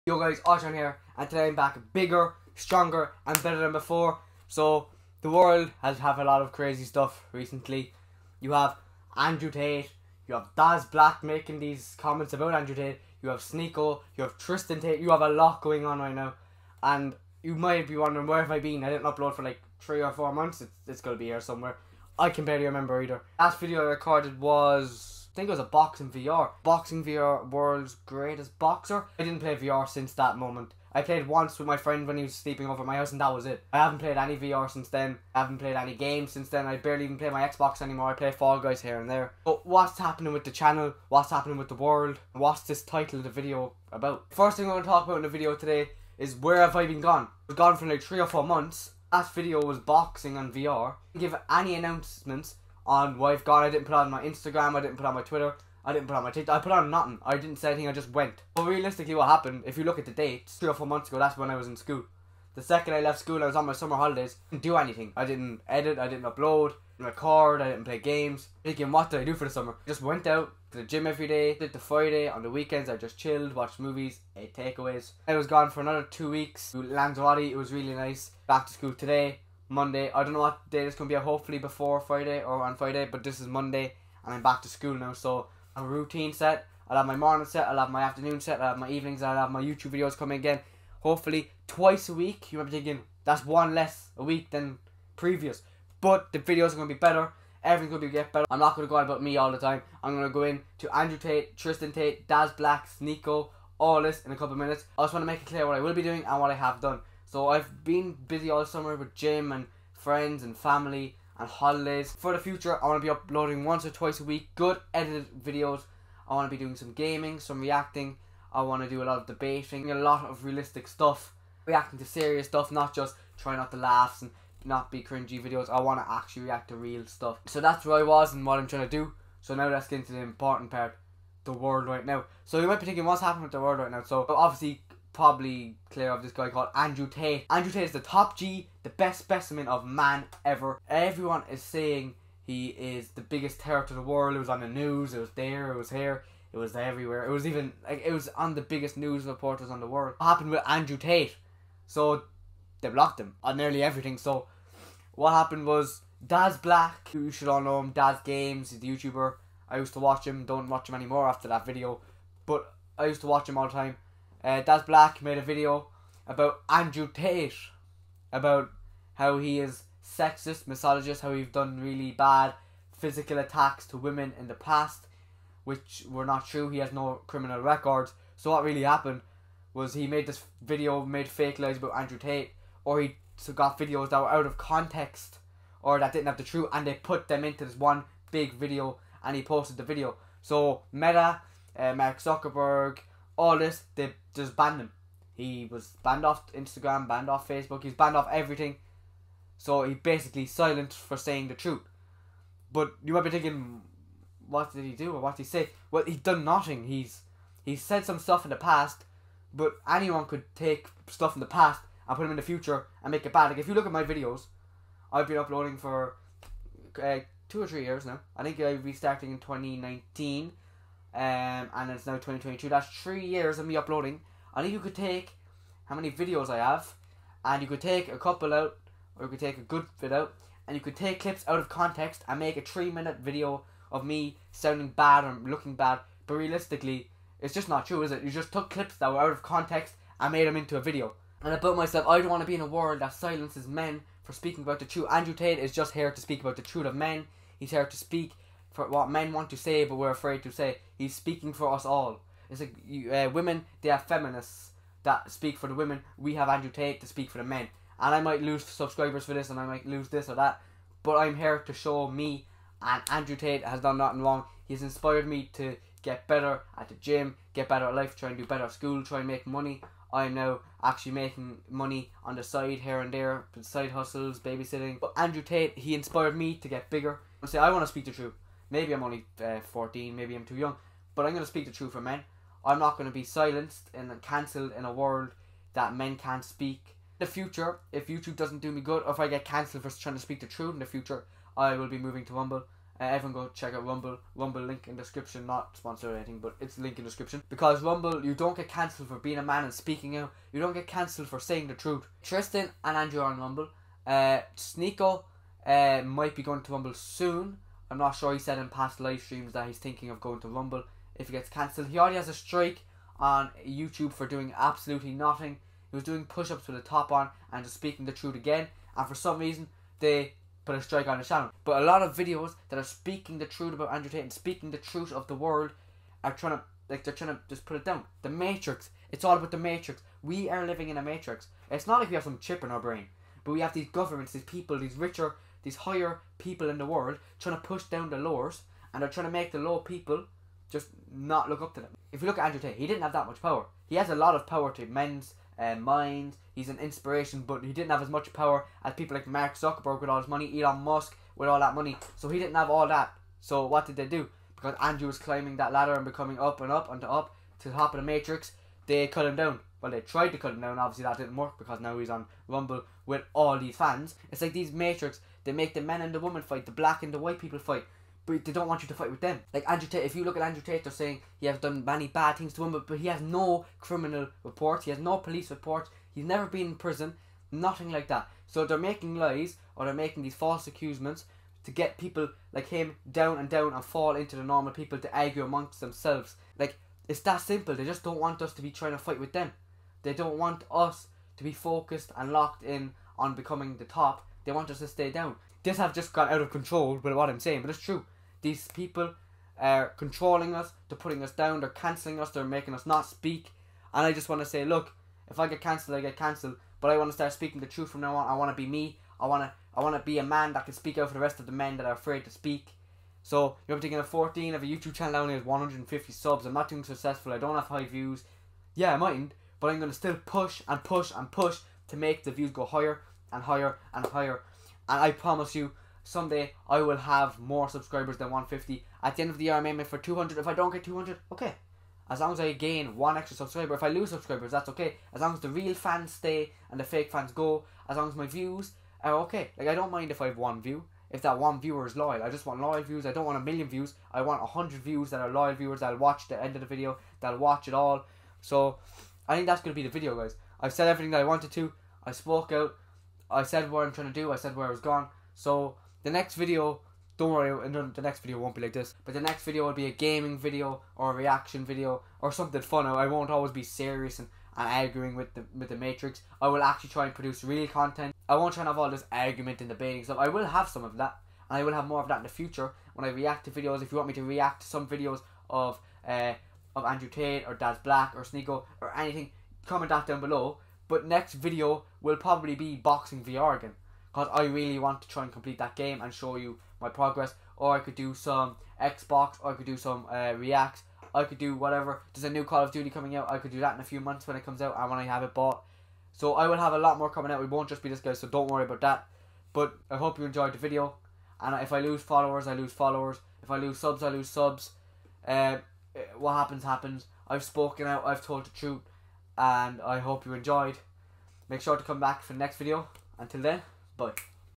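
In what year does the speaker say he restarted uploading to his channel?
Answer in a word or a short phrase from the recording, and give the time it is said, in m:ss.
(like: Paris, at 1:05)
2019, at 3:39.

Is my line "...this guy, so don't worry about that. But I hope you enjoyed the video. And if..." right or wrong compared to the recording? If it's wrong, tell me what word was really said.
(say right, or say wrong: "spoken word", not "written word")
right.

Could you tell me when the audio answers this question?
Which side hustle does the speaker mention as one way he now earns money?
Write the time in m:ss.
4:34.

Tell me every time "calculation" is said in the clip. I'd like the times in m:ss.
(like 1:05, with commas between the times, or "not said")
not said.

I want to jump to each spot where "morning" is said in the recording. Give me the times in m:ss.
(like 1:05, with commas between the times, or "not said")
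1:27.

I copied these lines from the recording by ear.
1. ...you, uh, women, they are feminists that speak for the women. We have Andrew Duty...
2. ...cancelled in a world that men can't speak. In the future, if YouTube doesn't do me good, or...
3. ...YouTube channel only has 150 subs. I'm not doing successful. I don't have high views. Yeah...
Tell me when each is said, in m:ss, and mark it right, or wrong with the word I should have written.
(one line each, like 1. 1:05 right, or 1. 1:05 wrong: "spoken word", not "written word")
1. 4:12 wrong: "Tate", not "Duty"
2. 4:44 right
3. 6:54 right.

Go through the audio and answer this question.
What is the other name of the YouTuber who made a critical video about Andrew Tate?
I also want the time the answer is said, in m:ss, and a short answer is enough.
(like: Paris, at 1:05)
Daz Games, at 2:37.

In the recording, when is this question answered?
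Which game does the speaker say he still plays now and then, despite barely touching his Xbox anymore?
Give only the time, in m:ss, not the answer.
0:38.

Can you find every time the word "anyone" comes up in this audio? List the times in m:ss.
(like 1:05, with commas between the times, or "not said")
3:29.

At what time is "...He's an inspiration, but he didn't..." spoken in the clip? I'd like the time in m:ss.
5:46.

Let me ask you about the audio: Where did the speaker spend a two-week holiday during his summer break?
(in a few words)
Lanzarote.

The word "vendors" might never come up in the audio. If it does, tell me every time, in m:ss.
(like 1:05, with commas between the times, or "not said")
not said.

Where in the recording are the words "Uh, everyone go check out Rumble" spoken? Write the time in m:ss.
4:52.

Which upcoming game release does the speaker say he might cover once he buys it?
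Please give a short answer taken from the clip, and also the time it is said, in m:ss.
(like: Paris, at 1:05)
Call of Duty, at 8:12.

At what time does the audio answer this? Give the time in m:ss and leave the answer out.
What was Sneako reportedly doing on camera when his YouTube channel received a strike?
5:16.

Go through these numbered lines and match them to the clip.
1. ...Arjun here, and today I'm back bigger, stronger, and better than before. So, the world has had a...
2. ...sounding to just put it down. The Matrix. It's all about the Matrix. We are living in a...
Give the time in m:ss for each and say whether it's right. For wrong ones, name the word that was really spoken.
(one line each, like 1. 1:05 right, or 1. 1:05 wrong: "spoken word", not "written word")
1. 0:00 right
2. 5:27 wrong: "trying", not "sounding".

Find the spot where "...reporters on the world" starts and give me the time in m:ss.
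2:29.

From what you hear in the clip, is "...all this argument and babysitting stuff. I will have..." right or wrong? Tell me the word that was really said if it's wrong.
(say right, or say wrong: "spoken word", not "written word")
wrong: "debating", not "babysitting".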